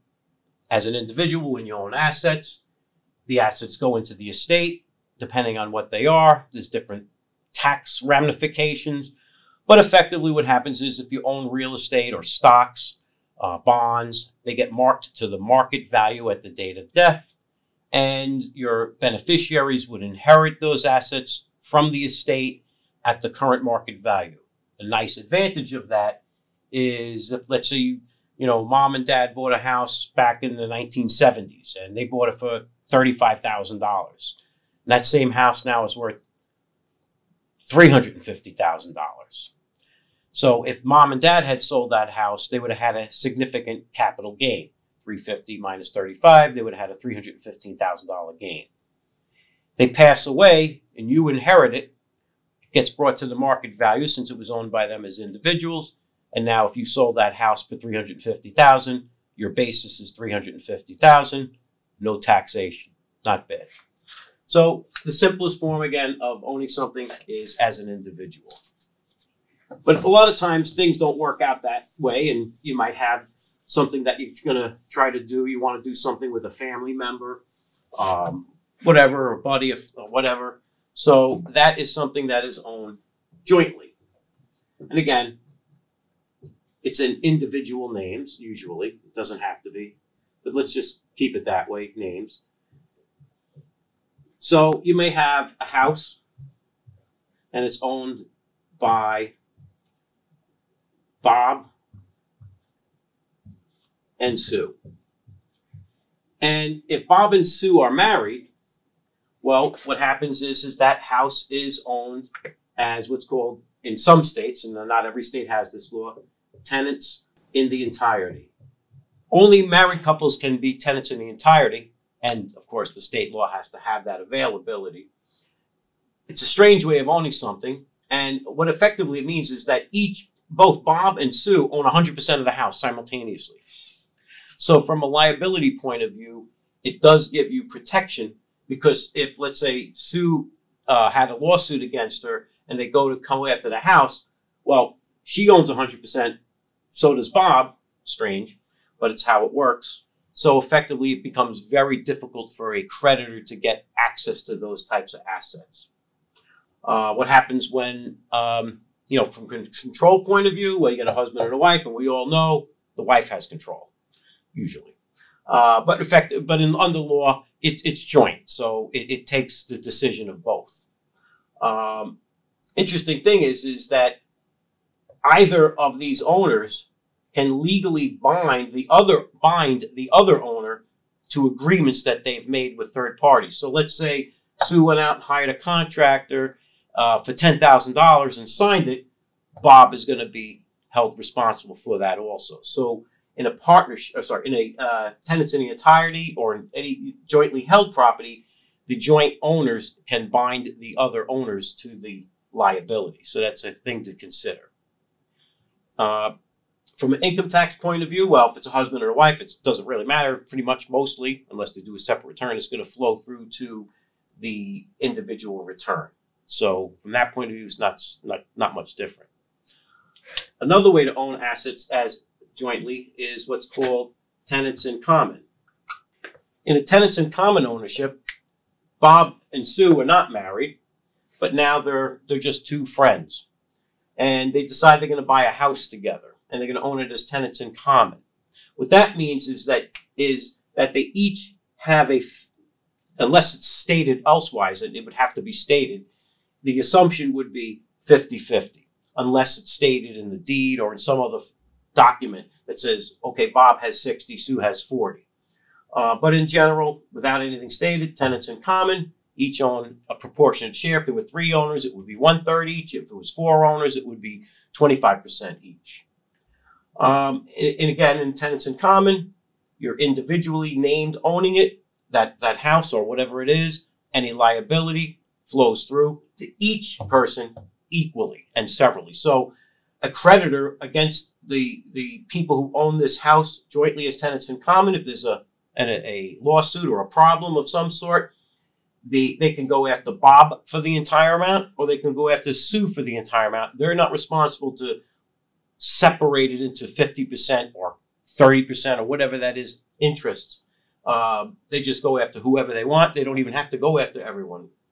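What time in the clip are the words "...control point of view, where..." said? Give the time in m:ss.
2:39.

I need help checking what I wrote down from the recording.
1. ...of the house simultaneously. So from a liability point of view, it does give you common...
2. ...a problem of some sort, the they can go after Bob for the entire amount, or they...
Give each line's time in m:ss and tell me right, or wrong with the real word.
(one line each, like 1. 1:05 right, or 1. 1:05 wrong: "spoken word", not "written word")
1. 2:12 wrong: "protection", not "common"
2. 4:46 right.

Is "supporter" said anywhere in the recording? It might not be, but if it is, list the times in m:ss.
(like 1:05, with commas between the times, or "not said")
not said.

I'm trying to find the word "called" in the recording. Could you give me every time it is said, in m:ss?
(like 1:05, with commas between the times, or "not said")
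1:53, 3:43.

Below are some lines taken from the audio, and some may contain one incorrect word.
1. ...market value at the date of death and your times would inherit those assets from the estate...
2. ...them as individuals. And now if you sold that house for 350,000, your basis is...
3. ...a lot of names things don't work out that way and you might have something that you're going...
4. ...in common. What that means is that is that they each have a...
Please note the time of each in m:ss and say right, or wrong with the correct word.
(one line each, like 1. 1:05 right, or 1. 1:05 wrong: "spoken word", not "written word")
1. 0:15 wrong: "beneficiaries", not "times"
2. 0:54 right
3. 1:10 wrong: "times", not "names"
4. 3:57 right.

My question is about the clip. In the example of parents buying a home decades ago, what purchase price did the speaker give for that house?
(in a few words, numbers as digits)
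$35,000.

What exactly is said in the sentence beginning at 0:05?
Depending on what they are, there's different tax ramifications.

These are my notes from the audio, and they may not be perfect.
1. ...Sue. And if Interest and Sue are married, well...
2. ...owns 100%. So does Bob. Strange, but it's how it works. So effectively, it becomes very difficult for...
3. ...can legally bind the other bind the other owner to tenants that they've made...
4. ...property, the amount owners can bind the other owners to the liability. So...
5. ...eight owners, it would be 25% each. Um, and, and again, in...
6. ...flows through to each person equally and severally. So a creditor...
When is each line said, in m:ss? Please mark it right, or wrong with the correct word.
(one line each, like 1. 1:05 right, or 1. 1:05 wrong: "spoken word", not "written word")
1. 1:44 wrong: "Bob", not "Interest"
2. 2:25 right
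3. 2:57 wrong: "agreements", not "tenants"
4. 3:17 wrong: "joint", not "amount"
5. 4:23 wrong: "four", not "eight"
6. 4:35 right.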